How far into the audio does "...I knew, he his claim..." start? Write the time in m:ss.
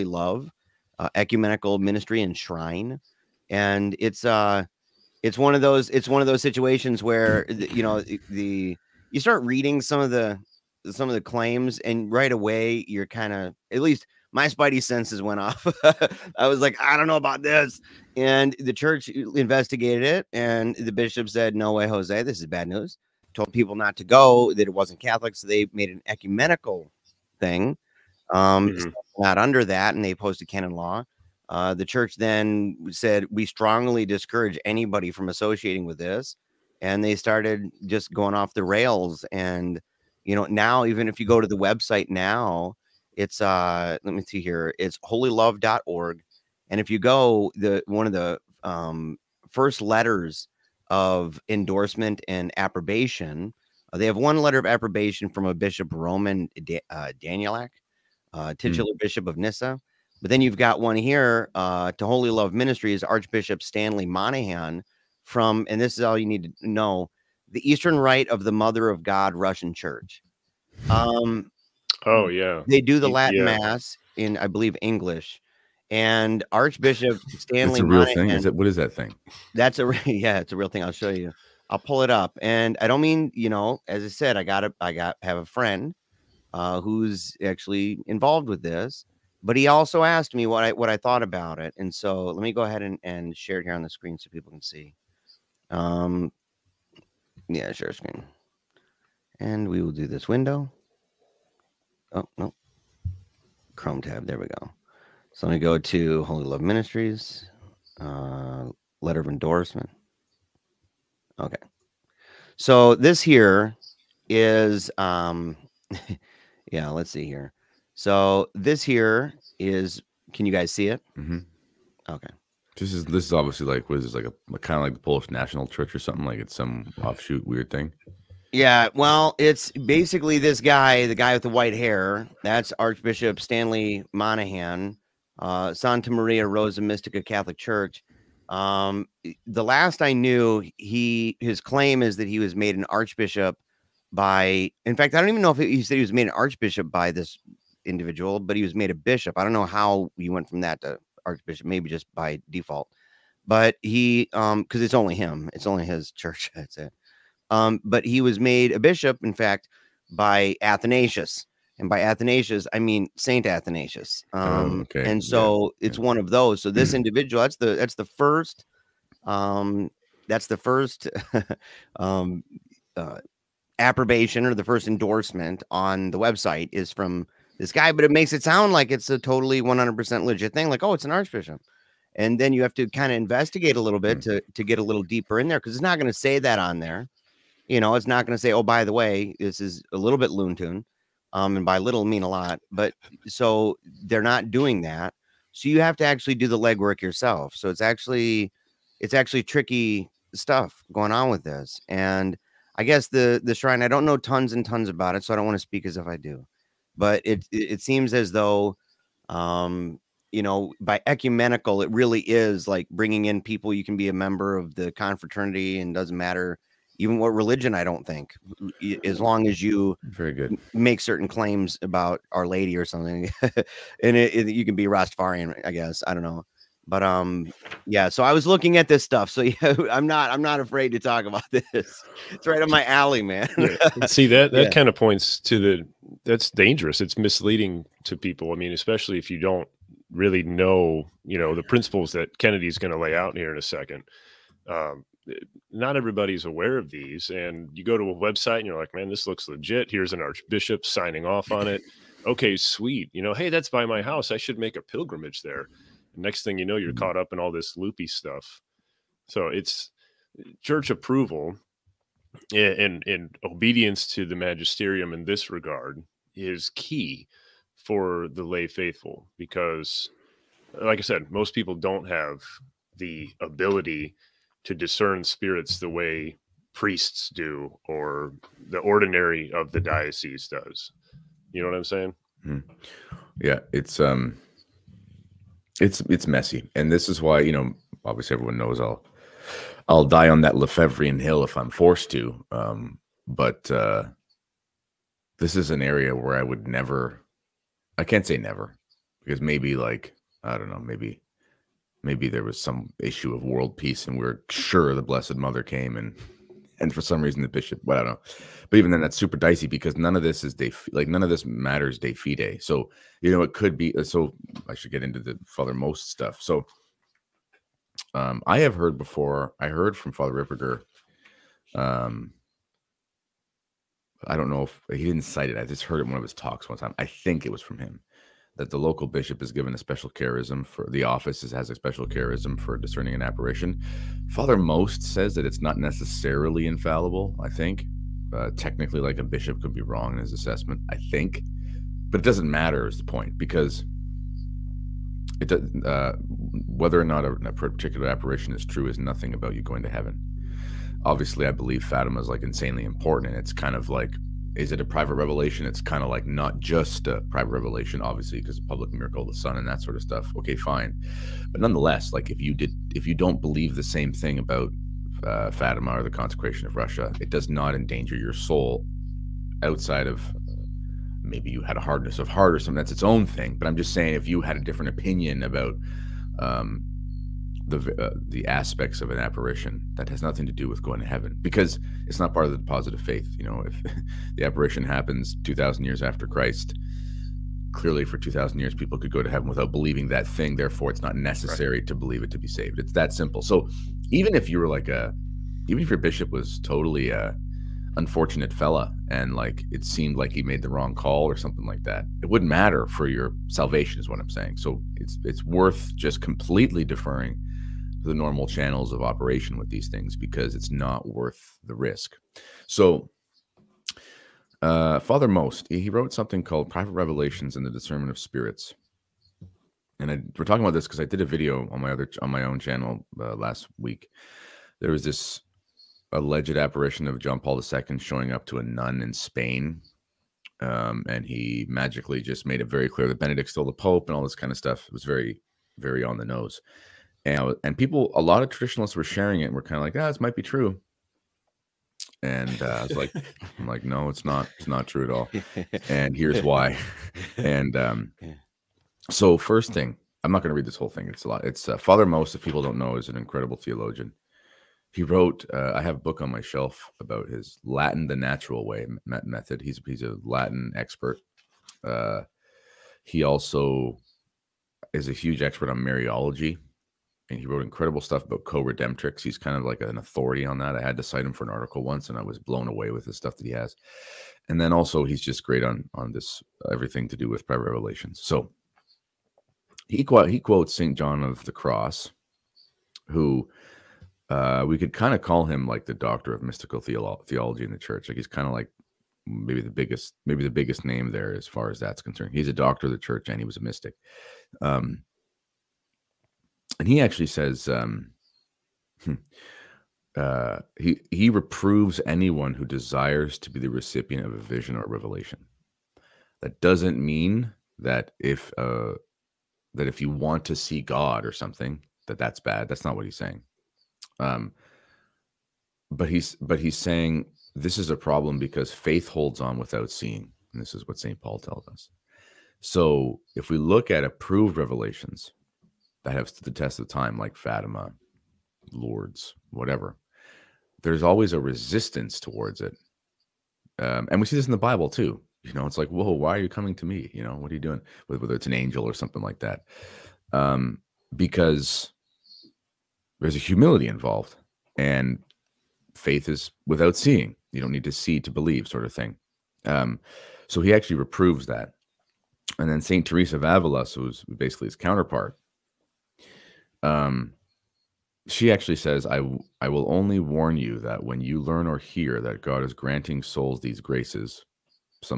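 2:20.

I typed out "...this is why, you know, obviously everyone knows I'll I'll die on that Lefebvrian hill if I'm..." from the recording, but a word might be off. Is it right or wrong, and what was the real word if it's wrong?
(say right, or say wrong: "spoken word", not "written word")
right.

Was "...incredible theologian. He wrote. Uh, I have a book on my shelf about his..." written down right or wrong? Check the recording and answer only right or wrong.
right.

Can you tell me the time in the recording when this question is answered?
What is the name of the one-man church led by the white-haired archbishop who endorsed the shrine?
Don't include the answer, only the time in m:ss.
2:15.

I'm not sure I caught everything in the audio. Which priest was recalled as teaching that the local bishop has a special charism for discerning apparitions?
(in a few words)
Father Ripperger.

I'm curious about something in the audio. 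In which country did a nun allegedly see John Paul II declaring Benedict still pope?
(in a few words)
Spain.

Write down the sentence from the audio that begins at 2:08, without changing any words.
Yeah, well, it's basically this guy, the guy with the white hair.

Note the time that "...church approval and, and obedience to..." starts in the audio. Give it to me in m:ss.
4:20.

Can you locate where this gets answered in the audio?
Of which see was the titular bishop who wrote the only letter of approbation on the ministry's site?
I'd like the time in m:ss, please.
0:59.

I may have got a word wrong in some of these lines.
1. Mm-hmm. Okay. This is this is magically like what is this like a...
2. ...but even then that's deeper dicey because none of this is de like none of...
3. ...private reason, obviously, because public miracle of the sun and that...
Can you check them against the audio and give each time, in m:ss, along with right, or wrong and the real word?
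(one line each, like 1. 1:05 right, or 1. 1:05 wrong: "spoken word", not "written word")
1. 2:01 wrong: "obviously", not "magically"
2. 5:08 wrong: "super", not "deeper"
3. 5:57 wrong: "revelation", not "reason".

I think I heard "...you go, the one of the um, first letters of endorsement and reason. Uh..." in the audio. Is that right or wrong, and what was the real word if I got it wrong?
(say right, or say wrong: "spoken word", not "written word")
wrong: "approbation", not "reason".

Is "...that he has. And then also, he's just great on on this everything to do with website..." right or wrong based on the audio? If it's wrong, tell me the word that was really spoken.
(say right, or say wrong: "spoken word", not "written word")
wrong: "private", not "website".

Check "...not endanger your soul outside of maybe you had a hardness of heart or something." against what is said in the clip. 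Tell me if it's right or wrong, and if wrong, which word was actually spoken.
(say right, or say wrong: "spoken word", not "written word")
right.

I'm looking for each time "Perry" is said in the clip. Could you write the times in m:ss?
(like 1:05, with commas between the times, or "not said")
not said.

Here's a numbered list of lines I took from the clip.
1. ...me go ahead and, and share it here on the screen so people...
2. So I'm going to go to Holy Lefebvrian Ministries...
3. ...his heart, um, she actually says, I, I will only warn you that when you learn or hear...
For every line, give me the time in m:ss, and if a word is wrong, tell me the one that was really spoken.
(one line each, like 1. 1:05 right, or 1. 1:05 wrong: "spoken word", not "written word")
1. 1:32 right
2. 1:45 wrong: "Love", not "Lefebvrian"
3. 9:14 wrong: "counterpart", not "heart".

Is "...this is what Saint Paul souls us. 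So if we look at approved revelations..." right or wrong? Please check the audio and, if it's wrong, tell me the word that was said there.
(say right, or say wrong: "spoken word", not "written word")
wrong: "tells", not "souls".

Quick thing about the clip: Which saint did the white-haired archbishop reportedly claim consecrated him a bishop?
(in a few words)
Saint Athanasius.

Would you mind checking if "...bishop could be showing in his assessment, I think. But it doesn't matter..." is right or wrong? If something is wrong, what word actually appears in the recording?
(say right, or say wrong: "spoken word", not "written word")
wrong: "wrong", not "showing".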